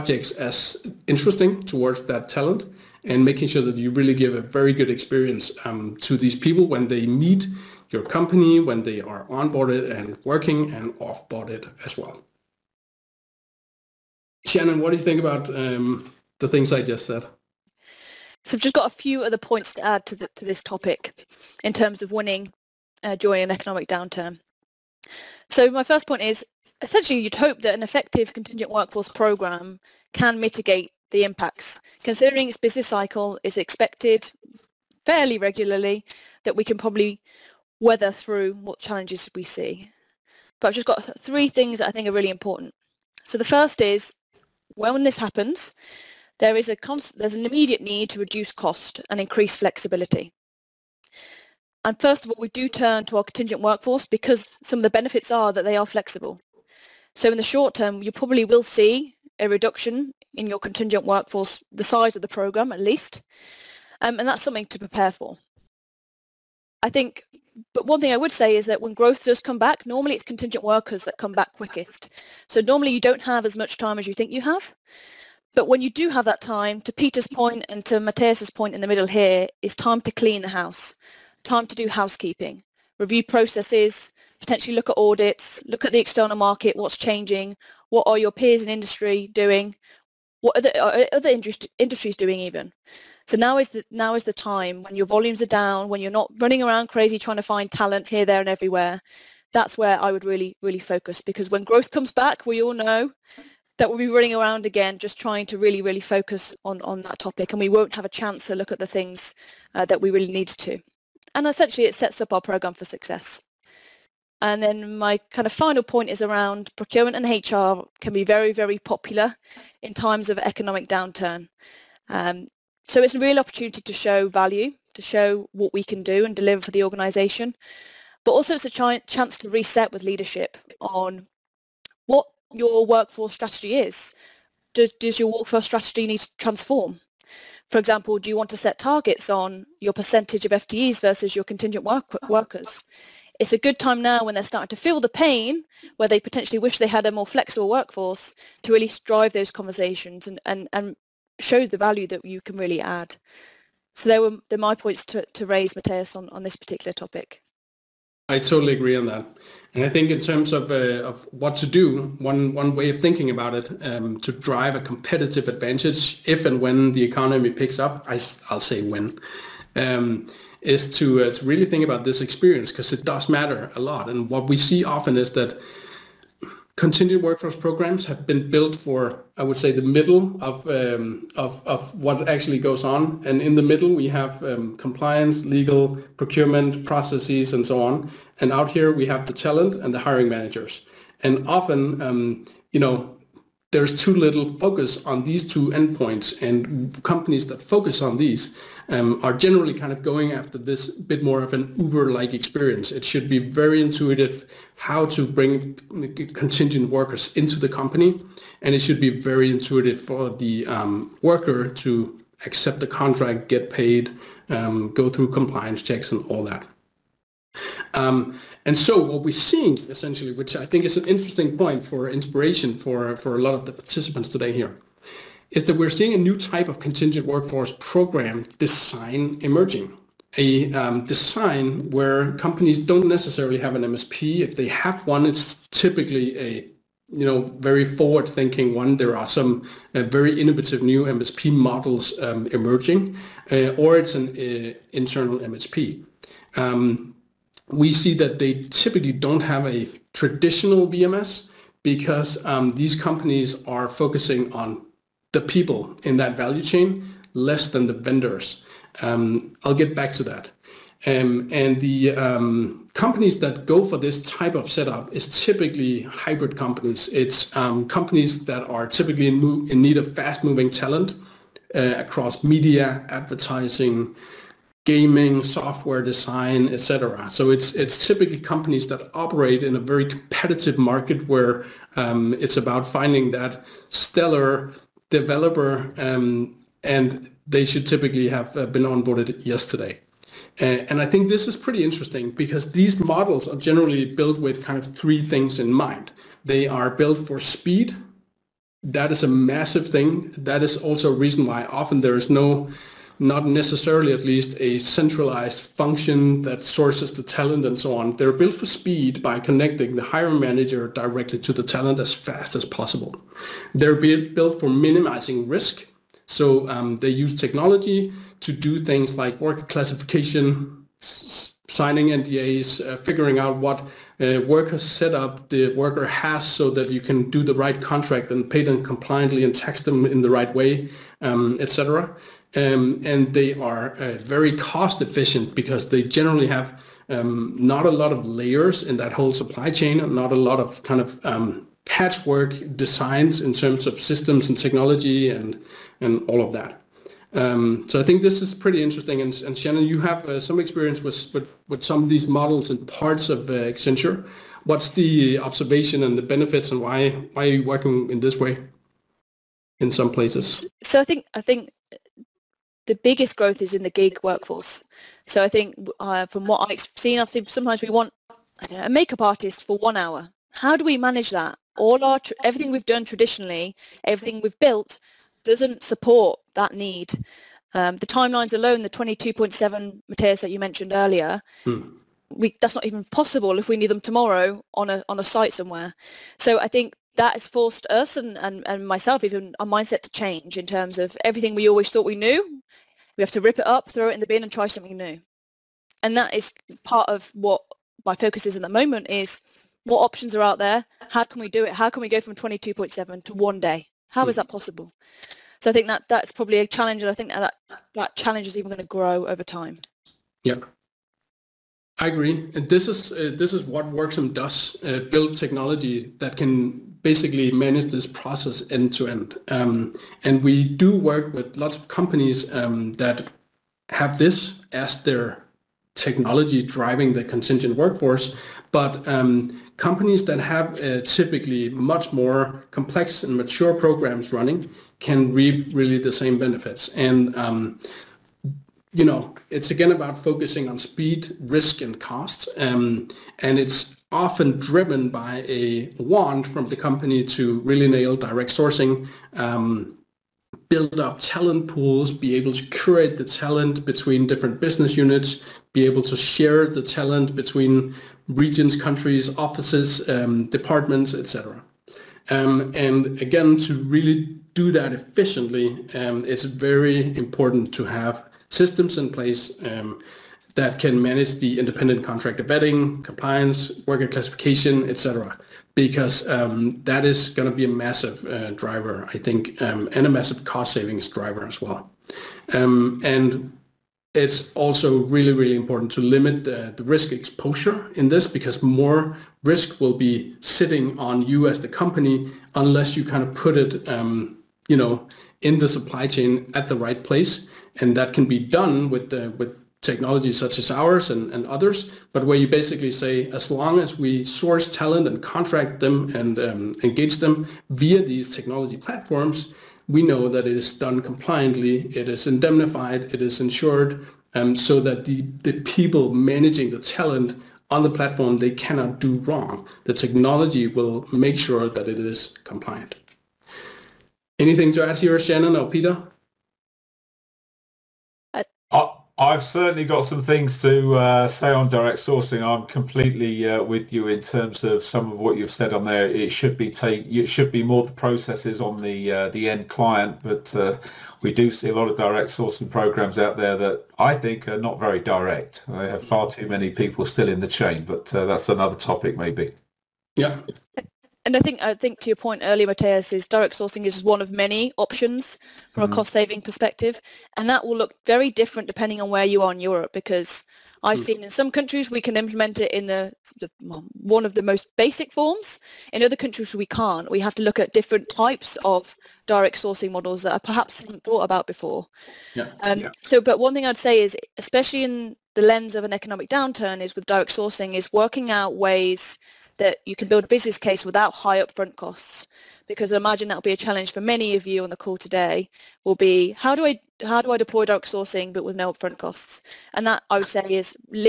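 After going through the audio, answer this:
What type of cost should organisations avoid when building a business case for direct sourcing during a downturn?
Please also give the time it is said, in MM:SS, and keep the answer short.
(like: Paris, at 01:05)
High upfront costs, at 09:41.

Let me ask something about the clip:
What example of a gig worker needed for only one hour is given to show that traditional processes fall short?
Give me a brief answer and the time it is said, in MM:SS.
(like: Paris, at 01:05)
A makeup artist, at 06:08.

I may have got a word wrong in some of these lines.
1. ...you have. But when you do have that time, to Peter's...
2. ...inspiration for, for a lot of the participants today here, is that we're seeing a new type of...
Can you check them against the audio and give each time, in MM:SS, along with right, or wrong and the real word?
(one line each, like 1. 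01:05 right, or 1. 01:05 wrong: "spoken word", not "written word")
1. 01:14 right
2. 03:42 right.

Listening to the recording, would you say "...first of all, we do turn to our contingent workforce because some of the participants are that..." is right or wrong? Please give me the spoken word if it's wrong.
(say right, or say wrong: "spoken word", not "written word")
wrong: "benefits", not "participants".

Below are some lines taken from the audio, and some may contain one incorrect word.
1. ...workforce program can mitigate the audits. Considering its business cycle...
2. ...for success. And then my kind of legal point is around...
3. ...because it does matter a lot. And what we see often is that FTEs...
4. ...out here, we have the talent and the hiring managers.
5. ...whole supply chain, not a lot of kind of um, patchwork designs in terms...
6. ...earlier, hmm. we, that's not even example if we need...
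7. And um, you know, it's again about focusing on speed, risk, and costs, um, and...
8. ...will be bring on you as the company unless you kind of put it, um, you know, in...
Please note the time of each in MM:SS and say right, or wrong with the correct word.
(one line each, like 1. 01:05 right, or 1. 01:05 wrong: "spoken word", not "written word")
1. 00:28 wrong: "impacts", not "audits"
2. 01:52 wrong: "final", not "legal"
3. 02:52 wrong: "Contingent", not "FTEs"
4. 03:08 right
5. 05:39 right
6. 06:20 wrong: "possible", not "example"
7. 07:16 right
8. 08:09 wrong: "sitting", not "bring".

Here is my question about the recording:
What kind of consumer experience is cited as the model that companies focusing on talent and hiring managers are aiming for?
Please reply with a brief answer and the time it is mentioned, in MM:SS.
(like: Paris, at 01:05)
Uber-like, at 03:21.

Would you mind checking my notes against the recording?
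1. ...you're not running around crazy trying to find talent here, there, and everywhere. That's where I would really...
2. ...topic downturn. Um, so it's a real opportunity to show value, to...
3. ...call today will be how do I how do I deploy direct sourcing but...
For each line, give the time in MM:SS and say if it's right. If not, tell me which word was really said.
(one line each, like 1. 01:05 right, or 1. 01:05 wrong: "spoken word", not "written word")
1. 01:36 right
2. 02:00 wrong: "economic", not "topic"
3. 09:44 right.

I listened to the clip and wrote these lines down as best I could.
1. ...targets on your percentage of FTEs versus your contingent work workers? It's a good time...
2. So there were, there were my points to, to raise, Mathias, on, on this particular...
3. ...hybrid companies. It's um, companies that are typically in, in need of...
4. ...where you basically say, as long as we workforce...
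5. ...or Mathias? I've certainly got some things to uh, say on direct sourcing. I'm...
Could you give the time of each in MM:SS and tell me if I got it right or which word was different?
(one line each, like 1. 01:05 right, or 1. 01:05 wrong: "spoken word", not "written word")
1. 02:18 right
2. 02:33 right
3. 04:26 right
4. 08:22 wrong: "source", not "workforce"
5. 08:45 wrong: "Peter", not "Mathias".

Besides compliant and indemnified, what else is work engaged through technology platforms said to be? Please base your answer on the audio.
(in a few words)
Insured.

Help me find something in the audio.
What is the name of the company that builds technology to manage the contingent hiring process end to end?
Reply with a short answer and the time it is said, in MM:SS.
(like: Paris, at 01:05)
Worksome, at 06:53.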